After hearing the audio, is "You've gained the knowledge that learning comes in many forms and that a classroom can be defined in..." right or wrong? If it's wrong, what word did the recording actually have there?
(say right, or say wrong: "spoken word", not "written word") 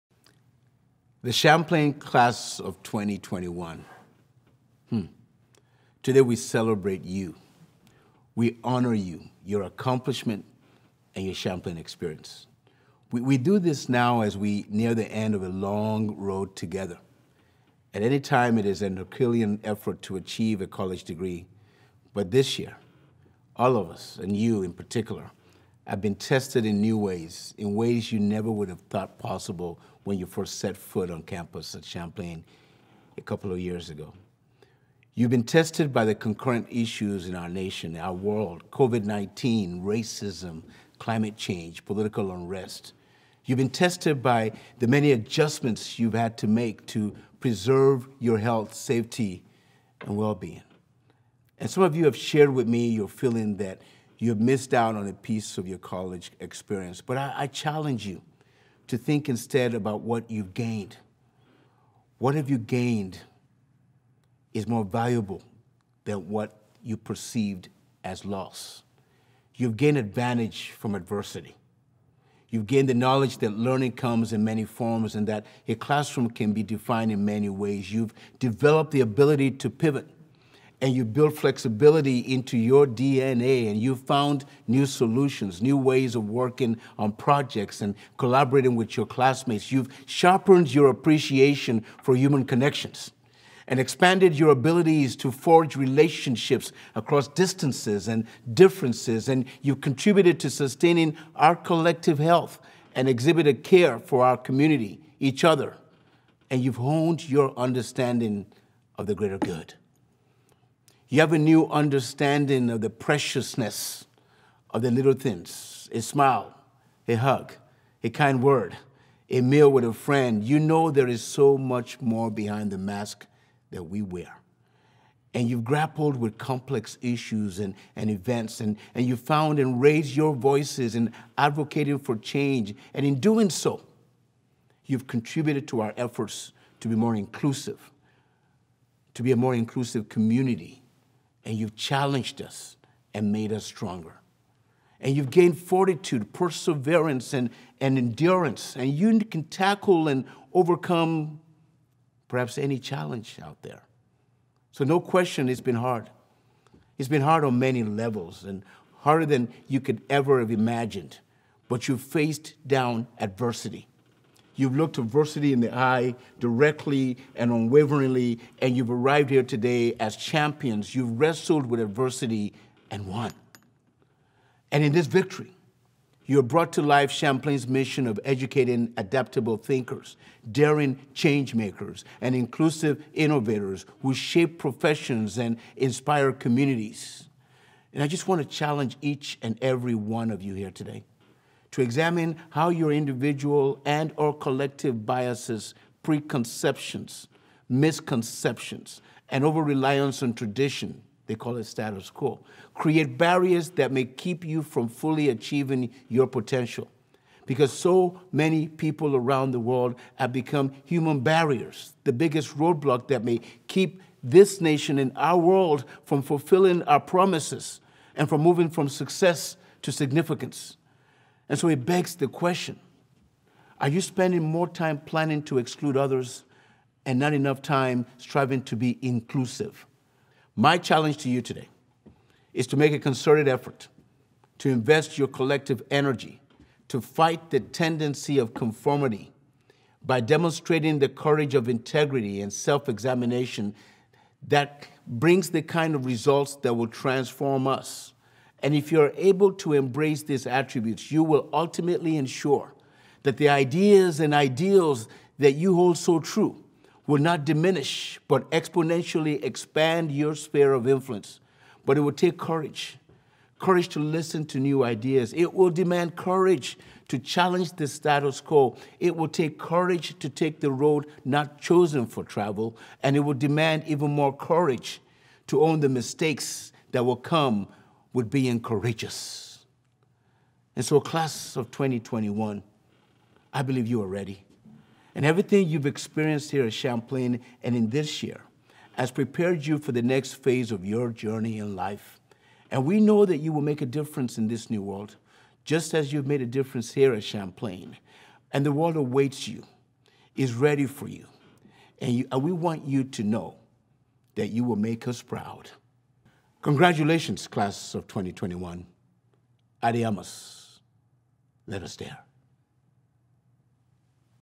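right.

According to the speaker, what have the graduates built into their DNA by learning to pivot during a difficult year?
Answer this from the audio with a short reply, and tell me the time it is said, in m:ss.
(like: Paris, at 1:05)
Flexibility, at 1:21.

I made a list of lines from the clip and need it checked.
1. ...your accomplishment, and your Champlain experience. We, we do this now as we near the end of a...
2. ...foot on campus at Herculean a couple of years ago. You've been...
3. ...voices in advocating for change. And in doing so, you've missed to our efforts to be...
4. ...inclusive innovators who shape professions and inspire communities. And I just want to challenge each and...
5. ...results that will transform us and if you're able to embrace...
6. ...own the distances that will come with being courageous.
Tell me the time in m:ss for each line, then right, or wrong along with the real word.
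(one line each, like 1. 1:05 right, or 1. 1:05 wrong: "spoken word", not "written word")
1. 0:09 right
2. 0:30 wrong: "Champlain", not "Herculean"
3. 2:10 wrong: "contributed", not "missed"
4. 3:02 right
5. 4:06 right
6. 4:35 wrong: "mistakes", not "distances".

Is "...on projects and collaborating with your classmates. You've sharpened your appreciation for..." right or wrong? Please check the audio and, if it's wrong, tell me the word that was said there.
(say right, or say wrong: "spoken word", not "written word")
right.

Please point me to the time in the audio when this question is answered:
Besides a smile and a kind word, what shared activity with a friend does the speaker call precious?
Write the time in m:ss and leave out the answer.
1:59.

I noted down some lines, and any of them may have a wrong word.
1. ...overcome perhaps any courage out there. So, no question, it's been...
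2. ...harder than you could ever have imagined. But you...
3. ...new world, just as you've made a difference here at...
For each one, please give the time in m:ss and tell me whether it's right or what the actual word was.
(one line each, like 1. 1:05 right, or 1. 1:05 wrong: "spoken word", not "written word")
1. 2:30 wrong: "challenge", not "courage"
2. 2:38 right
3. 4:54 right.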